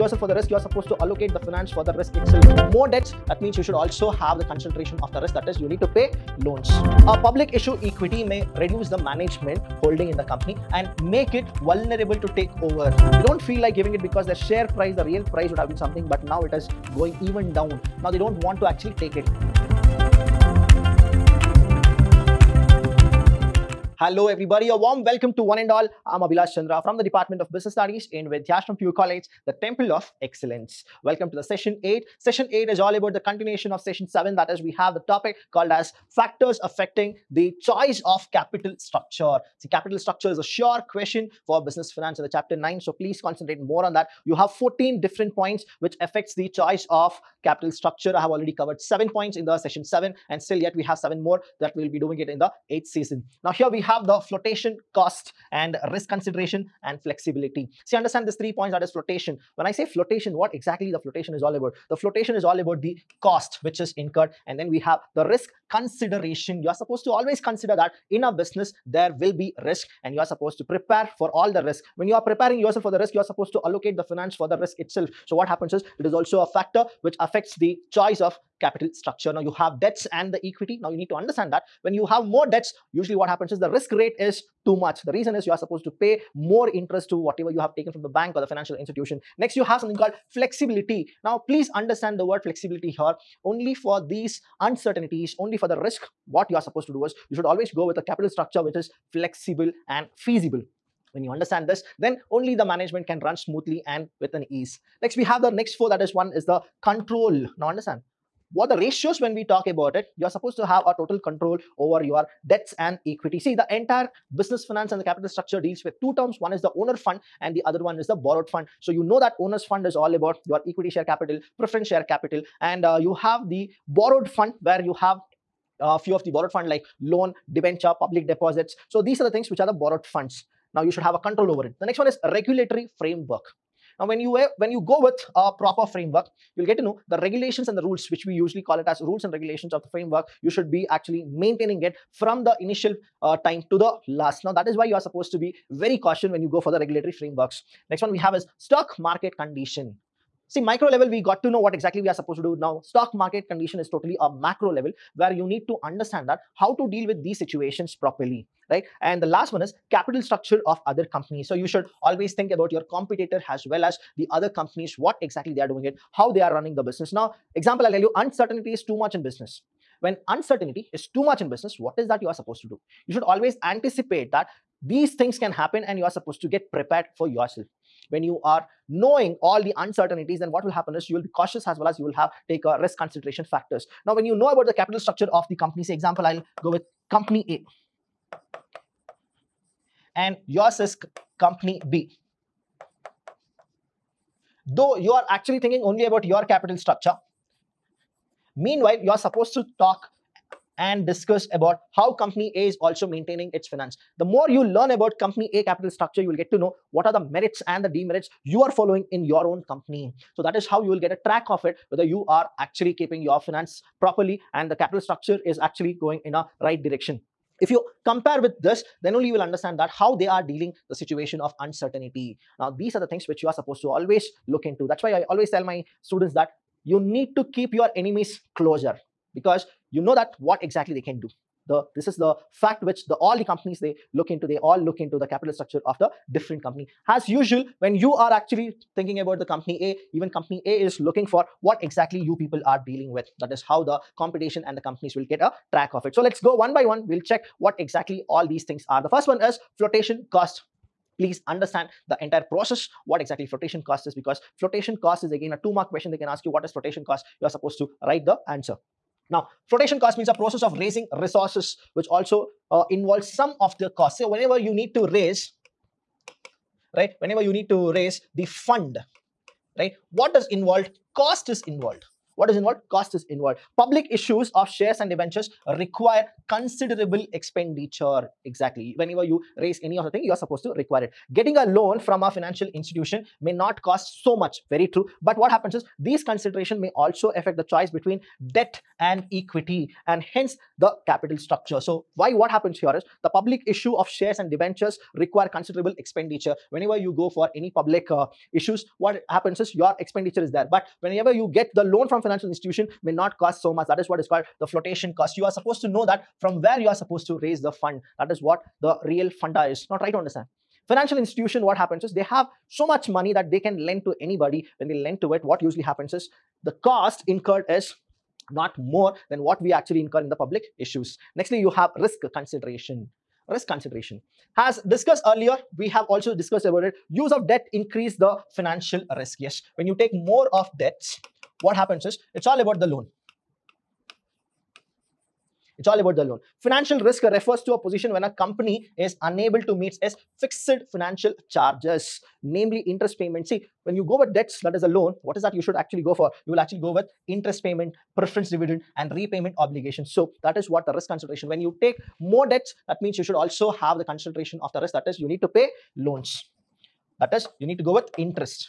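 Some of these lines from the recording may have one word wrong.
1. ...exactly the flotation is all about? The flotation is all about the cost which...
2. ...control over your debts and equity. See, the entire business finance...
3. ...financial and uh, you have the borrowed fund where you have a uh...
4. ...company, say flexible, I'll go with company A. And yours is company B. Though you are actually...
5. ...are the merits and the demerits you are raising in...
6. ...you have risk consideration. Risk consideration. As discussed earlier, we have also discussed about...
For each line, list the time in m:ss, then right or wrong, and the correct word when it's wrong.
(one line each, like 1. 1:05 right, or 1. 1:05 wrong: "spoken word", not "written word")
1. 1:00 right
2. 1:51 right
3. 2:02 wrong: "capital", not "financial"
4. 3:05 wrong: "example", not "flexible"
5. 3:27 wrong: "following", not "raising"
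6. 5:21 right.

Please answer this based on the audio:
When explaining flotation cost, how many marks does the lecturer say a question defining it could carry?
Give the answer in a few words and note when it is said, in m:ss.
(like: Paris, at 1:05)
2, at 4:15.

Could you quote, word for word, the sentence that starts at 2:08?
So these are the things which are the borrowed funds.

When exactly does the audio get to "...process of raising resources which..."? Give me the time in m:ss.
4:20.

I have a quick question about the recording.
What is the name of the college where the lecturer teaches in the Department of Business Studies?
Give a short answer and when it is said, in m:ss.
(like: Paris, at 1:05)
Vidhyaashram Pure College, at 0:28.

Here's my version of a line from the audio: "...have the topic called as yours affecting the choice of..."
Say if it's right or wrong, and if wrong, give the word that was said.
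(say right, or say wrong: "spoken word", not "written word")
wrong: "factors", not "yours".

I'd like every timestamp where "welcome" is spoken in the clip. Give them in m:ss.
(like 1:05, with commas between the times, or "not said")
0:25, 0:31.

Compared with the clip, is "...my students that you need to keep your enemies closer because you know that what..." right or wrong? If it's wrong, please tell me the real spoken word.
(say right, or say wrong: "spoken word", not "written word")
right.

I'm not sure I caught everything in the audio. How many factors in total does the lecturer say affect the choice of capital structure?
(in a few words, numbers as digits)
14.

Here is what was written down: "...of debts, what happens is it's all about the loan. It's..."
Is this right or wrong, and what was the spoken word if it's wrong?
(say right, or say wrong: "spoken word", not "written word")
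right.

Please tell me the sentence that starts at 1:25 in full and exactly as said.
The reason is you are supposed to pay more interest to whatever you have taken from the bank or the financial institution.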